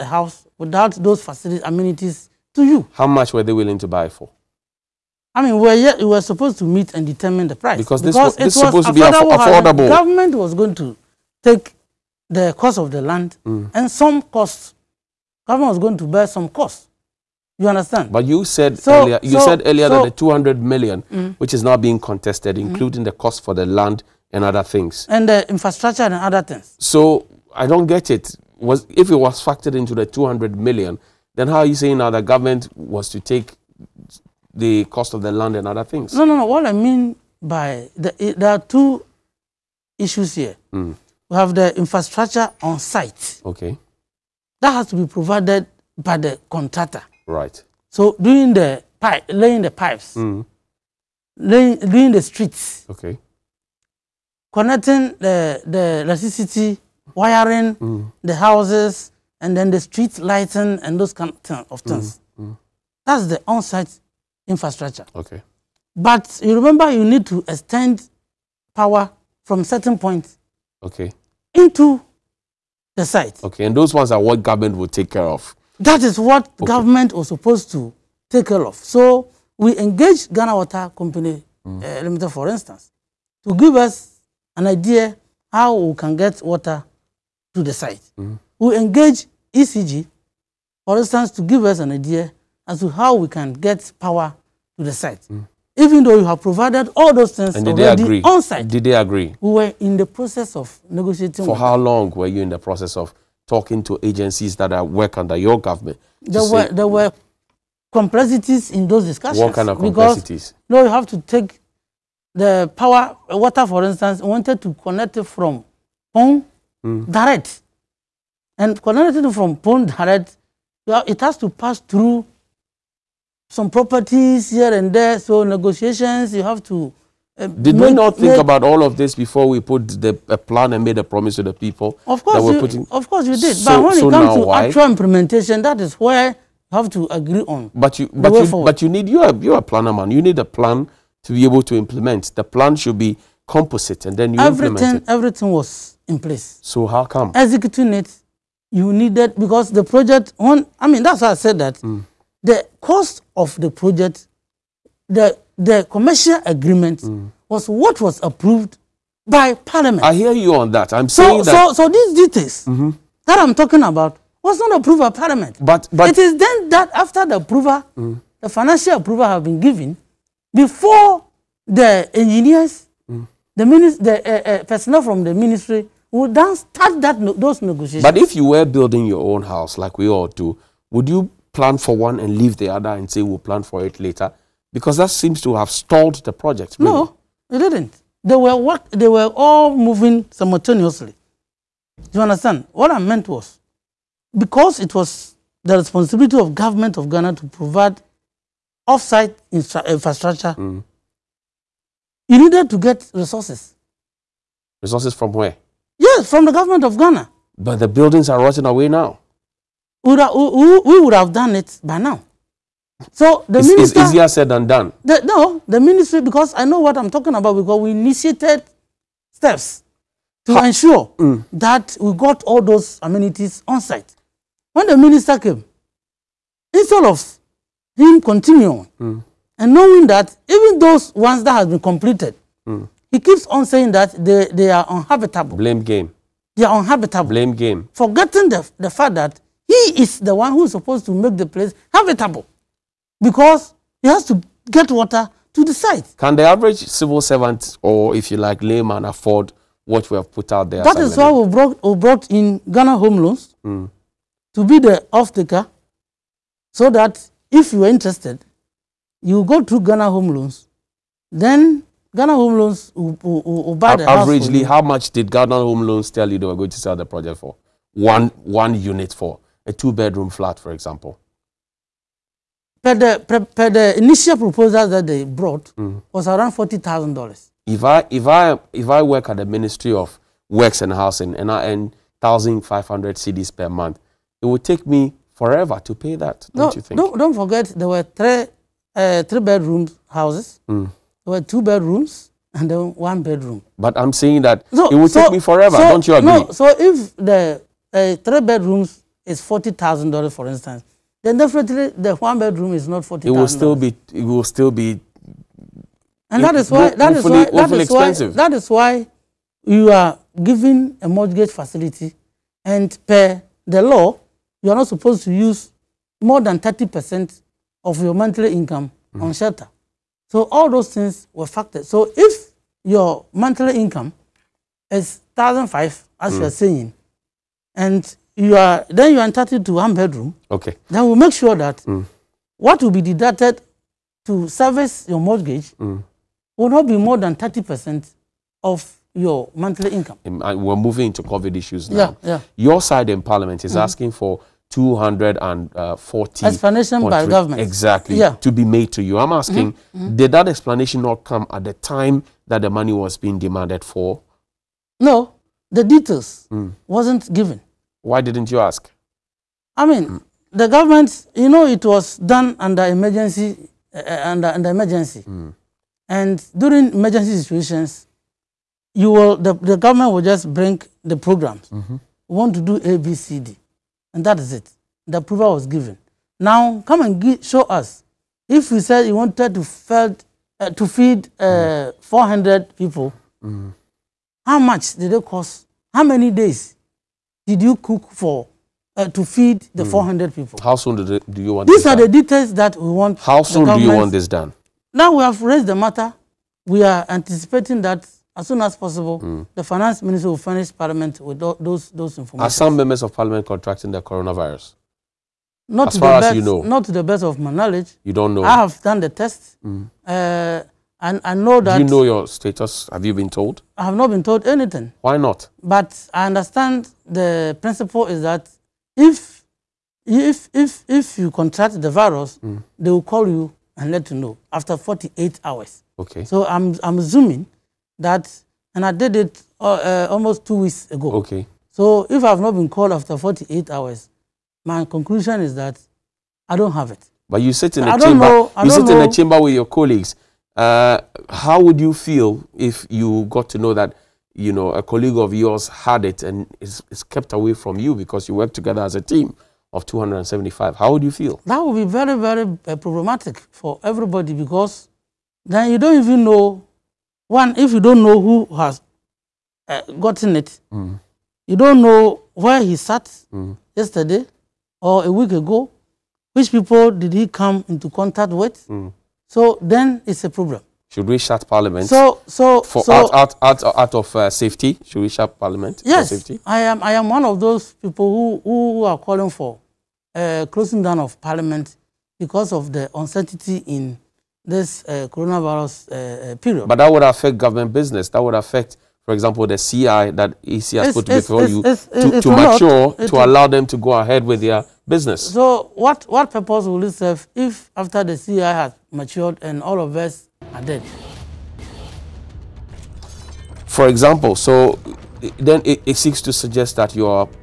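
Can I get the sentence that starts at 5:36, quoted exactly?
will not be more than thirty percent of your monthly income.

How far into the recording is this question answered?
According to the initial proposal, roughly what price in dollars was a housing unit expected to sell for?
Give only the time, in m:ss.
4:36.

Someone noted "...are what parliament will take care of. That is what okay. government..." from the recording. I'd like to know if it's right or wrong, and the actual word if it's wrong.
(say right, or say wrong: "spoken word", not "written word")
wrong: "government", not "parliament".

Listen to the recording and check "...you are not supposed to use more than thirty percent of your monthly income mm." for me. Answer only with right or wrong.
right.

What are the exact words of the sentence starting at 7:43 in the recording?
yesterday or a week ago, which people did he come into contact with.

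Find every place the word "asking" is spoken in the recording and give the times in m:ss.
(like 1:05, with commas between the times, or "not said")
5:43, 5:49.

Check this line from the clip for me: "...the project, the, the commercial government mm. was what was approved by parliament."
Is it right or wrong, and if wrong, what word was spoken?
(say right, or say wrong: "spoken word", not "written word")
wrong: "agreement", not "government".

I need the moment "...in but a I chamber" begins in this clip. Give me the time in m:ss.
7:17.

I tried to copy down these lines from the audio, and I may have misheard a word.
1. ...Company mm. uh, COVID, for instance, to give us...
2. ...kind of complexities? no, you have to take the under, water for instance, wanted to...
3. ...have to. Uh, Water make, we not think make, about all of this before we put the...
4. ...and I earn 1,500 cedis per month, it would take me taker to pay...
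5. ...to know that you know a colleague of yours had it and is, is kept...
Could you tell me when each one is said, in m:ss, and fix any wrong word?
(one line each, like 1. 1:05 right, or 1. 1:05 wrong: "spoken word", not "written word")
1. 1:20 wrong: "Limited", not "COVID"
2. 1:49 wrong: "power", not "under"
3. 2:06 wrong: "Did", not "Water"
4. 4:41 wrong: "forever", not "taker"
5. 7:23 right.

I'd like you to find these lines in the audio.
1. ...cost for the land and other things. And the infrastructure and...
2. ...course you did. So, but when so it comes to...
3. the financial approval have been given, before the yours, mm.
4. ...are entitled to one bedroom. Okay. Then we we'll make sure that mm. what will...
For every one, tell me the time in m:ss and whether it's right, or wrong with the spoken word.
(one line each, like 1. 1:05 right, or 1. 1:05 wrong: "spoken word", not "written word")
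1. 0:23 right
2. 2:13 right
3. 2:48 wrong: "engineers", not "yours"
4. 5:29 right.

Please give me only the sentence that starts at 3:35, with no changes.
The, no, the ministry, because I know what I'm talking about, because we initiated steps to ha ensure mm.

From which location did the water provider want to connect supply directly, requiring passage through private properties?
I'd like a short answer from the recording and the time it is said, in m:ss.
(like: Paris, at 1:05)
Kpong, at 1:59.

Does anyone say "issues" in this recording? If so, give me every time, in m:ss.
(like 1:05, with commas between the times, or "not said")
0:39, 5:41.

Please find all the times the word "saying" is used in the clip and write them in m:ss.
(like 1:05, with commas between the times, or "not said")
0:31, 2:41, 3:53, 4:54, 5:26.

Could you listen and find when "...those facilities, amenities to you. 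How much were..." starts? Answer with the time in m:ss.
0:00.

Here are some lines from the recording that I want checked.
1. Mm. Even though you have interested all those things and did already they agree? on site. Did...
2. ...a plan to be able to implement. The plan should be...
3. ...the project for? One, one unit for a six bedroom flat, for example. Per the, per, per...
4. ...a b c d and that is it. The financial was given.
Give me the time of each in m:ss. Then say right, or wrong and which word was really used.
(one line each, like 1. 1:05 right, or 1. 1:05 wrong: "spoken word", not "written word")
1. 1:35 wrong: "provided", not "interested"
2. 2:20 right
3. 4:26 wrong: "two", not "six"
4. 6:12 wrong: "approval", not "financial".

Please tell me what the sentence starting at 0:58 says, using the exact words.
the houses, and then the street lighting and those kind of mm, things.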